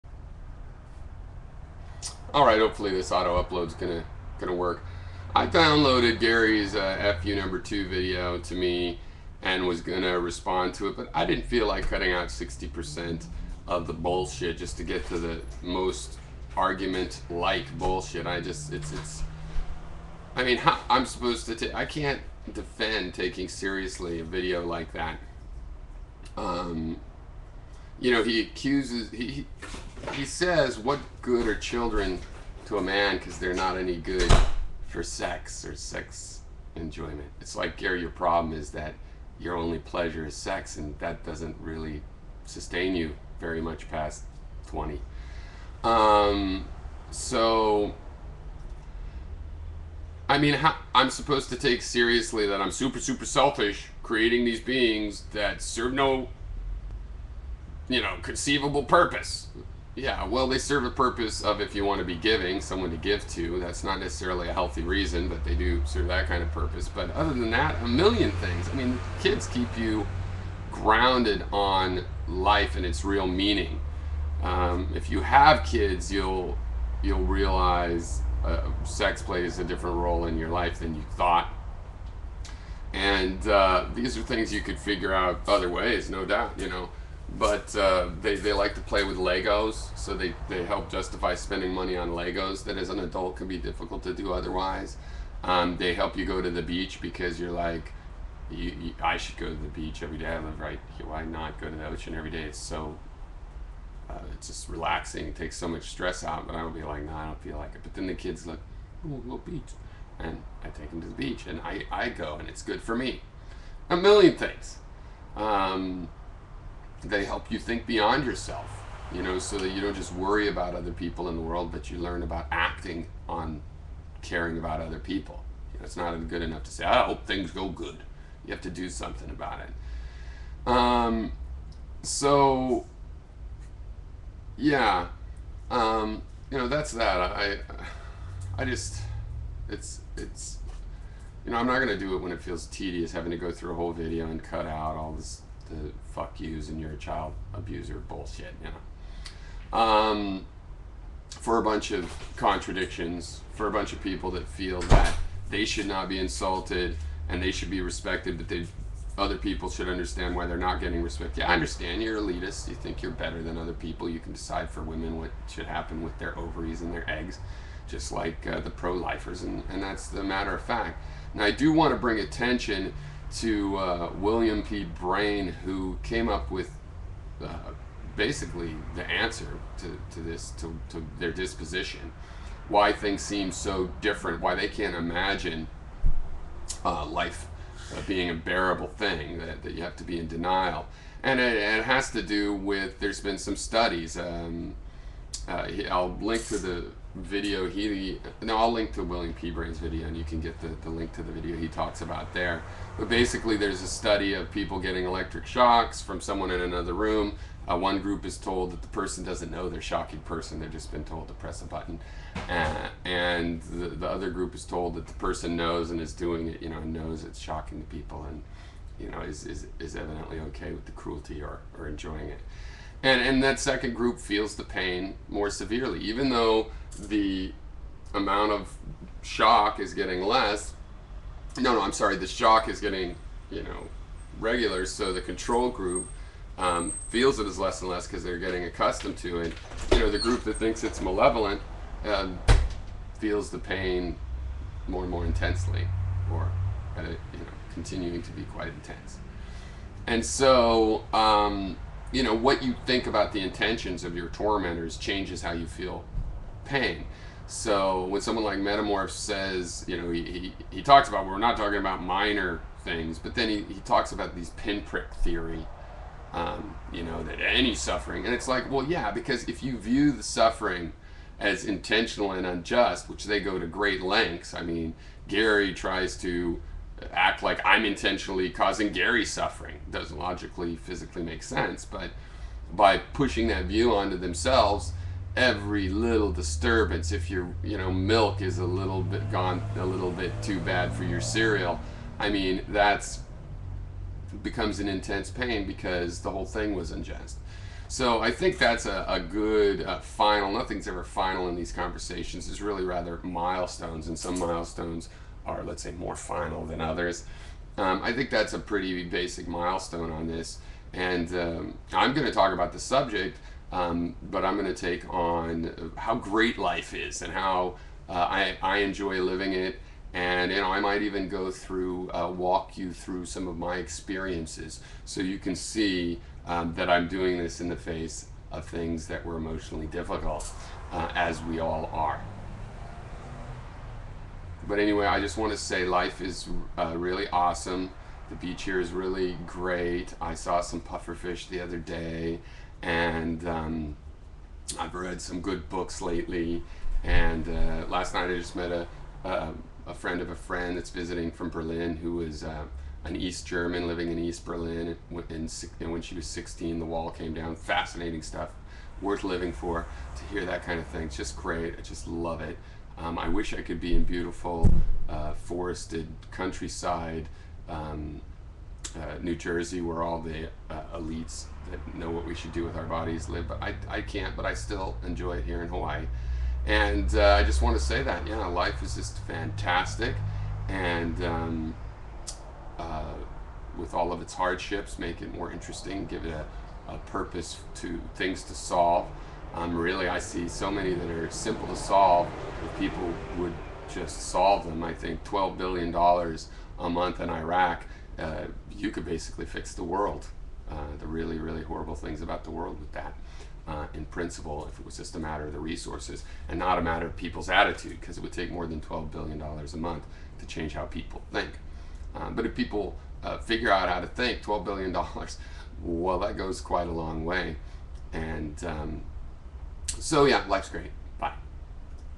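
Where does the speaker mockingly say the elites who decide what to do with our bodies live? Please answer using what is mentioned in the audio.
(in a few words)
New Jersey.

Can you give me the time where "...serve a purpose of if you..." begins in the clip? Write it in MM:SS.
01:00.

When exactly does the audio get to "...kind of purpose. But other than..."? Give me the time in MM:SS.
01:06.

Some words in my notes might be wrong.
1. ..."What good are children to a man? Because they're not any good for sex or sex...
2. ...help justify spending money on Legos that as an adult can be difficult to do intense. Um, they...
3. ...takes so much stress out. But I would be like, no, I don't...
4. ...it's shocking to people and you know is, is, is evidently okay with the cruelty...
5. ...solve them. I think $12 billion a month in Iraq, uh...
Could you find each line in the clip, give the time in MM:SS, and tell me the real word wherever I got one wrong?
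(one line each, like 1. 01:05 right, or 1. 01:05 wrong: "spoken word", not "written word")
1. 00:30 right
2. 01:30 wrong: "otherwise", not "intense"
3. 01:45 right
4. 03:37 right
5. 06:34 right.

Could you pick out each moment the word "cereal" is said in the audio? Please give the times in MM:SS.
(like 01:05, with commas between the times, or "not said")
04:51.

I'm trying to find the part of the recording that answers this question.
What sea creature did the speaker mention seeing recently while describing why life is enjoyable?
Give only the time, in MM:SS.
05:40.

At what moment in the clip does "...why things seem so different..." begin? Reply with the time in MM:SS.
03:02.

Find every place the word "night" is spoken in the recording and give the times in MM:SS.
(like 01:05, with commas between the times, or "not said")
05:48.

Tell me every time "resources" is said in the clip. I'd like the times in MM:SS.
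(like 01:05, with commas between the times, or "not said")
06:45.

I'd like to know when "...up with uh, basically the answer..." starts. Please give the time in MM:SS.
02:56.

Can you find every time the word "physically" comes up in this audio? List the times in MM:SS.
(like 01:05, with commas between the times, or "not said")
04:40.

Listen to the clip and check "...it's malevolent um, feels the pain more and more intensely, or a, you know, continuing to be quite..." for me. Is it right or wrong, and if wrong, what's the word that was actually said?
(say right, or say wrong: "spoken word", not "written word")
right.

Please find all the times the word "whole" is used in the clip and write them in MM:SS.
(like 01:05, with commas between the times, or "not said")
02:23, 04:56.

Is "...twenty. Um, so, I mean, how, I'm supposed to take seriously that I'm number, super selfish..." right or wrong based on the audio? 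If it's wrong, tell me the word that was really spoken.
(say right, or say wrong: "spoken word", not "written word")
wrong: "super", not "number".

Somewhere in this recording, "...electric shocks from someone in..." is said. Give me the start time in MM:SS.
03:25.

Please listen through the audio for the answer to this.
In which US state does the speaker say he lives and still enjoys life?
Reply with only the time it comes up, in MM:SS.
06:15.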